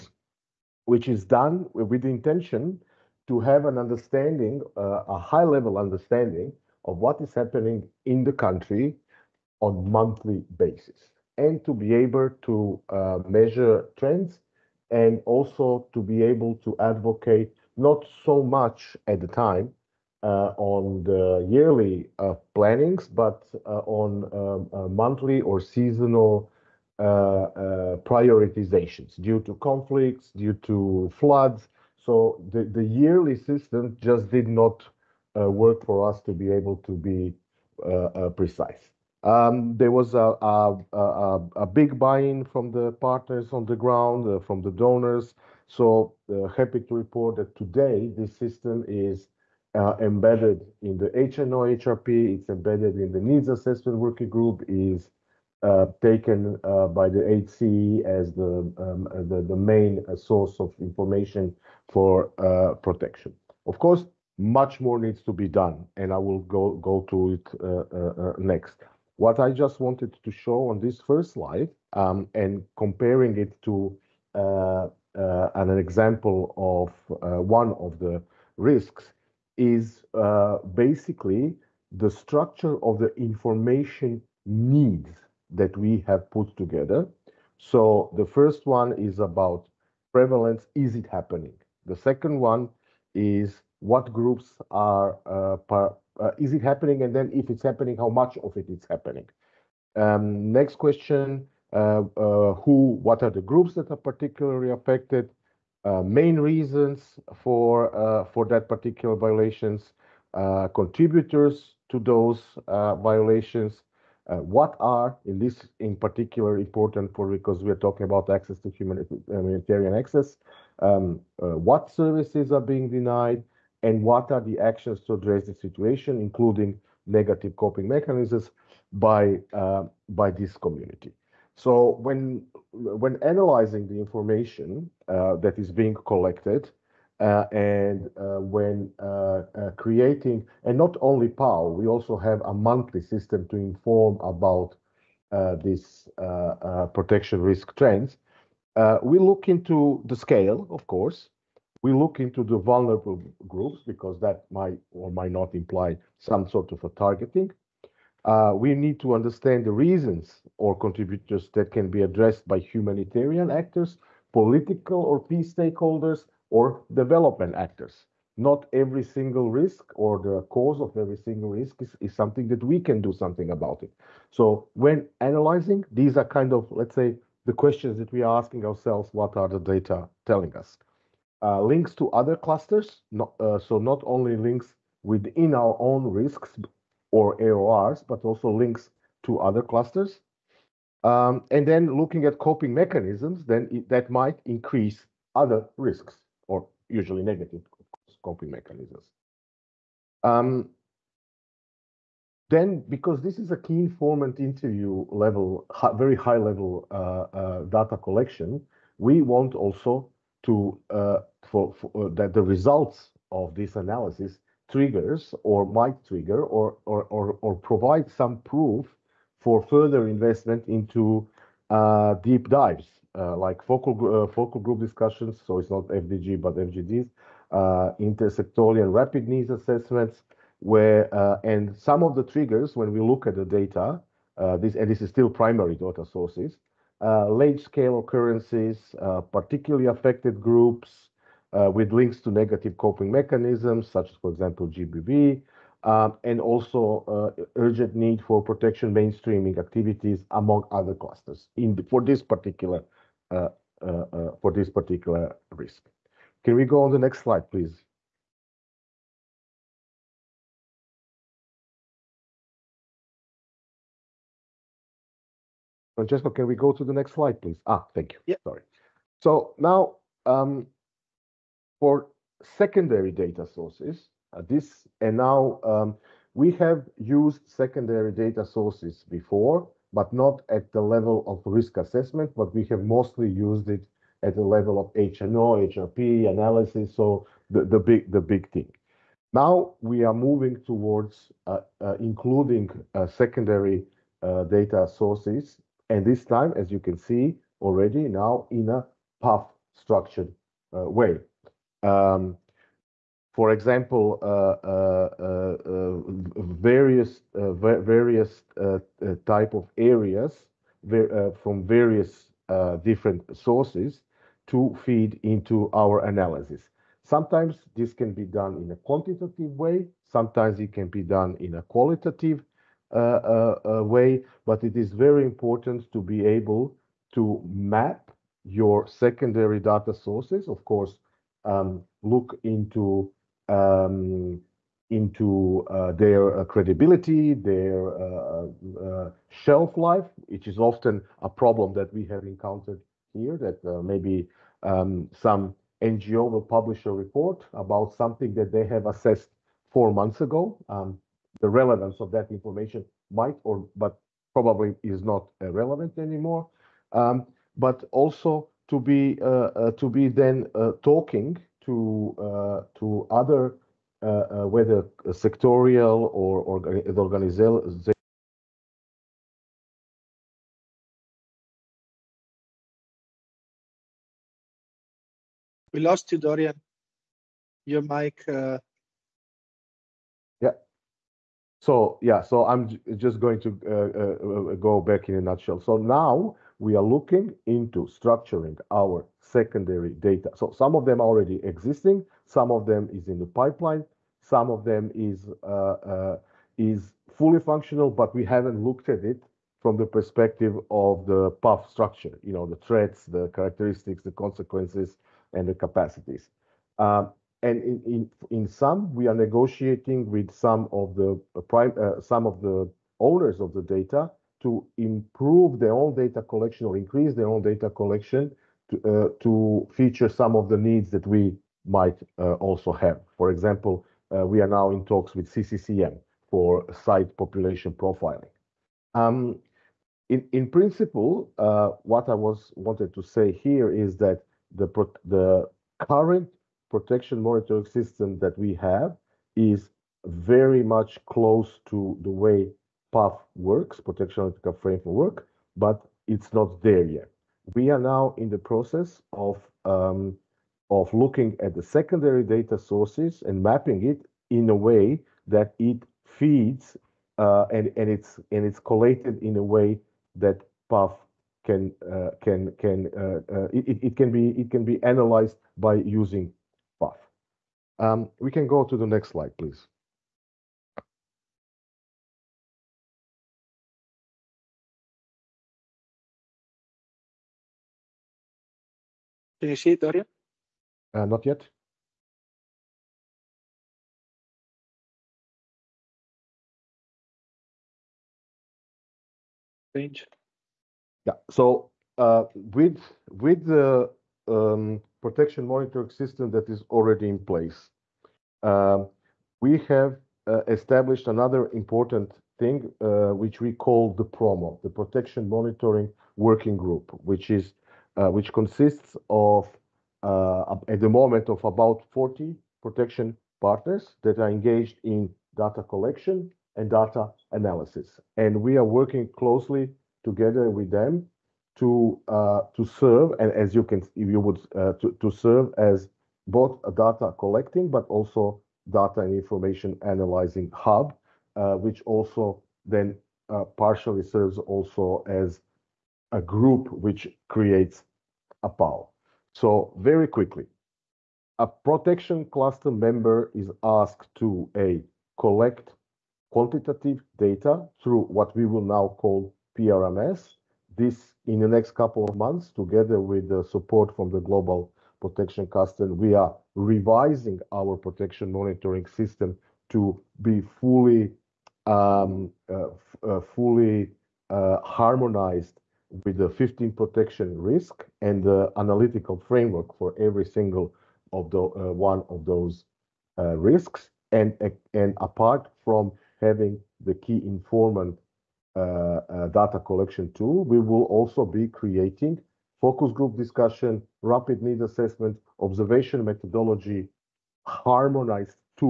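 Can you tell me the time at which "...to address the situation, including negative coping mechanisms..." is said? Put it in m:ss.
2:05.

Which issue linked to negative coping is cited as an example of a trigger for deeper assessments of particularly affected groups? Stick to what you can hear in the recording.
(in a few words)
GBV.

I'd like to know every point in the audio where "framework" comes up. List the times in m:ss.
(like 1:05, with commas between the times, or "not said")
7:24, 9:29.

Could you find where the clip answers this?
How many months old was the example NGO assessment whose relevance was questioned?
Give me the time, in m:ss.
5:49.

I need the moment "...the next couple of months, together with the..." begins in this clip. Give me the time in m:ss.
9:11.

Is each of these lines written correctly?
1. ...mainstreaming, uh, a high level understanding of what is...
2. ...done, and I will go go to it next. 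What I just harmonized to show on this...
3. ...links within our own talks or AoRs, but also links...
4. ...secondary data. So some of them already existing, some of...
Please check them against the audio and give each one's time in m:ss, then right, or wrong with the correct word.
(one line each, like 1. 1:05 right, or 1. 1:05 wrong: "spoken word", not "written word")
1. 0:03 wrong: "understanding", not "mainstreaming"
2. 1:05 wrong: "wanted", not "harmonized"
3. 3:04 wrong: "risks", not "talks"
4. 6:29 right.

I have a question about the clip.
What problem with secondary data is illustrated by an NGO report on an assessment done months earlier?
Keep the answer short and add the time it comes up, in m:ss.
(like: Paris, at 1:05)
shelf life, at 5:39.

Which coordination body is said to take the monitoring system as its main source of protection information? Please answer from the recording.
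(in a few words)
HCT.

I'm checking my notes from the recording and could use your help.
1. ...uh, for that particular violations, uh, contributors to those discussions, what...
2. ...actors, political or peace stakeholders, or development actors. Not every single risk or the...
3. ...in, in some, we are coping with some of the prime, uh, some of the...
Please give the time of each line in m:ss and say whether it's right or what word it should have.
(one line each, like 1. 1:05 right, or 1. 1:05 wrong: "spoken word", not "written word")
1. 1:47 wrong: "violations", not "discussions"
2. 2:43 right
3. 6:47 wrong: "negotiating", not "coping".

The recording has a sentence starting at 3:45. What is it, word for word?
So it's not FDG but FGDs, intersectorial rapid needs assessments, where and some of the triggers when we look at the data.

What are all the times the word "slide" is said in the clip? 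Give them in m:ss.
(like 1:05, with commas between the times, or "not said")
1:11, 4:17, 4:27, 7:49.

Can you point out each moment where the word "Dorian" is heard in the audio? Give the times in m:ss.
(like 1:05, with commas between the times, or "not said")
6:16, 7:59.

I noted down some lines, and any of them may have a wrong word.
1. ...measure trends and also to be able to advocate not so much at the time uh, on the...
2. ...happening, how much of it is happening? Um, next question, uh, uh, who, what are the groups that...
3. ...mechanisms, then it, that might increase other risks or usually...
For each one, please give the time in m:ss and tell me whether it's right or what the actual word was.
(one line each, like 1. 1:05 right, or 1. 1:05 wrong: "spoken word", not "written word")
1. 0:13 right
2. 1:37 right
3. 3:12 right.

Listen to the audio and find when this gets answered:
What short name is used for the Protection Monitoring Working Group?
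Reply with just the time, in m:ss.
8:24.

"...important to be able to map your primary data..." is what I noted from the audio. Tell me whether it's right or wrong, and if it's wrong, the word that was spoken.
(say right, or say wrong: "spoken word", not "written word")
wrong: "secondary", not "primary".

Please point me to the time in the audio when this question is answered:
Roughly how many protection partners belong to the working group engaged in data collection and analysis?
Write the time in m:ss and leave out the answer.
8:31.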